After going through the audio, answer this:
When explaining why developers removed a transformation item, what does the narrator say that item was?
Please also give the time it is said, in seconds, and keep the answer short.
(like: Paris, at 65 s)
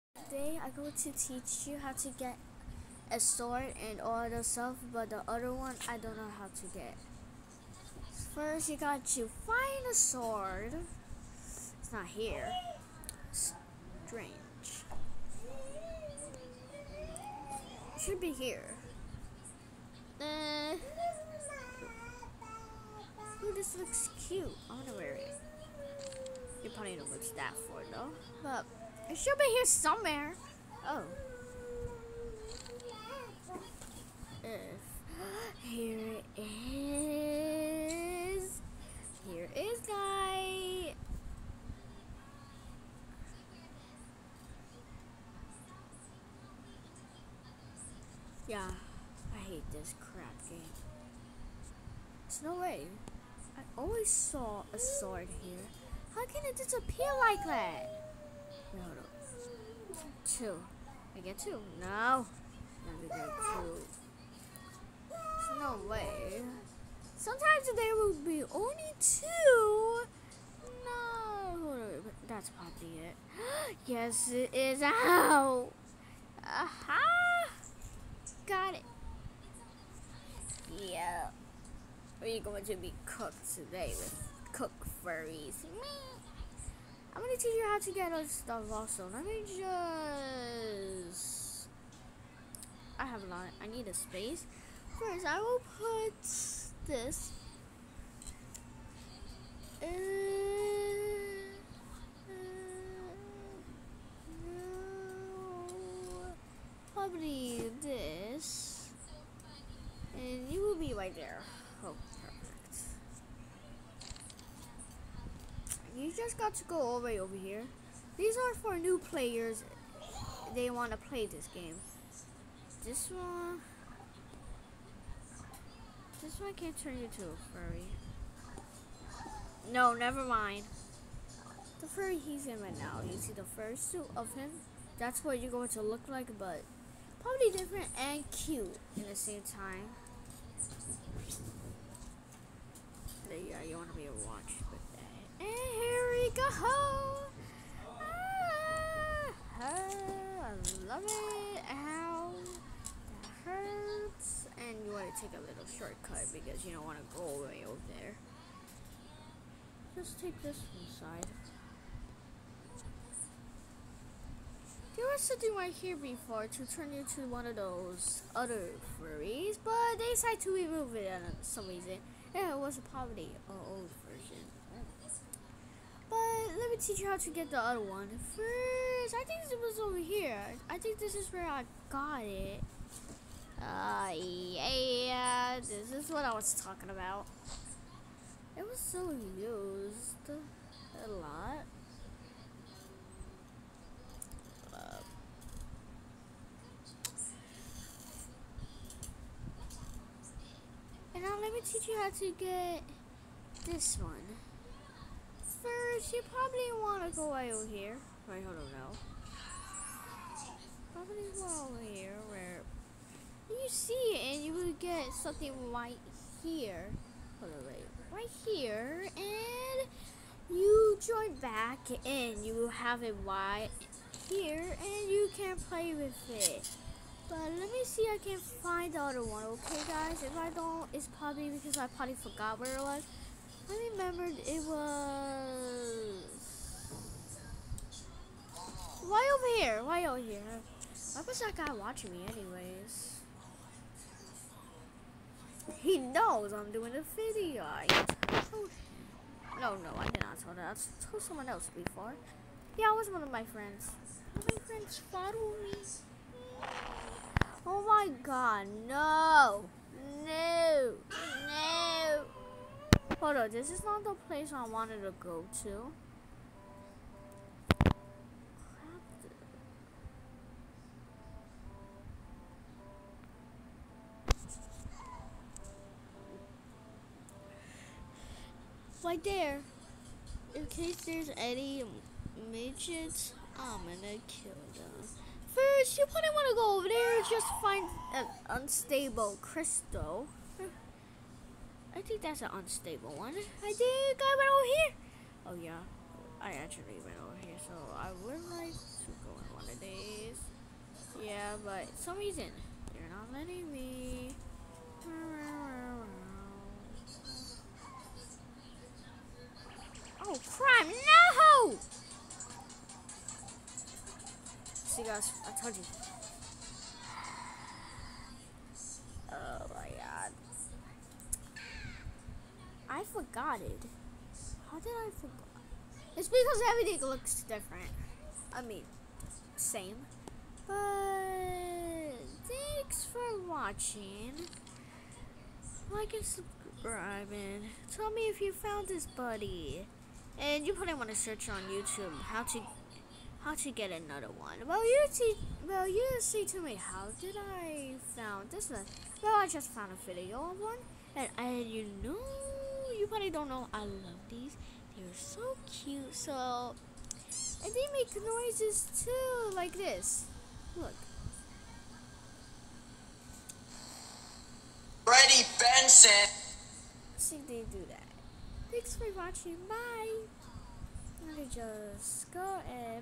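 a poverty, at 172 s.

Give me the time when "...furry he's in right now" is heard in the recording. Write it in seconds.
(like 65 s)
131 s.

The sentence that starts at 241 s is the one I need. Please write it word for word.
Why was that guy watching me anyways?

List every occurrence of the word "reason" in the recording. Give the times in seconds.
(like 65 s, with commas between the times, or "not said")
171 s, 302 s.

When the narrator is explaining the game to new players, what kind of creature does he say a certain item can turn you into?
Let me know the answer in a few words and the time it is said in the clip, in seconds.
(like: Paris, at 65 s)
a furry, at 126 s.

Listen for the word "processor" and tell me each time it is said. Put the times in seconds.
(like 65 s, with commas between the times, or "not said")
not said.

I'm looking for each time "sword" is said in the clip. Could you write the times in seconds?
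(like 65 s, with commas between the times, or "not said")
3 s, 9 s, 54 s.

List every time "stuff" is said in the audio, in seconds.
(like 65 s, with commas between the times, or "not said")
4 s, 88 s.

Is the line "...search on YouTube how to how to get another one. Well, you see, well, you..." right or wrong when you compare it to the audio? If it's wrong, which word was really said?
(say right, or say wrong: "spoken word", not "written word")
right.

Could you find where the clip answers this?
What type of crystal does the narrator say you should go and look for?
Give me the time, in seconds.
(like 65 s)
288 s.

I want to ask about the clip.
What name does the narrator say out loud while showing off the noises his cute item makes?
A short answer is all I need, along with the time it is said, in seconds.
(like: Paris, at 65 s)
Freddie Benson, at 365 s.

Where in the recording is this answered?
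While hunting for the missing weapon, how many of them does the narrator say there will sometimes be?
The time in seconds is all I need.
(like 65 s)
68 s.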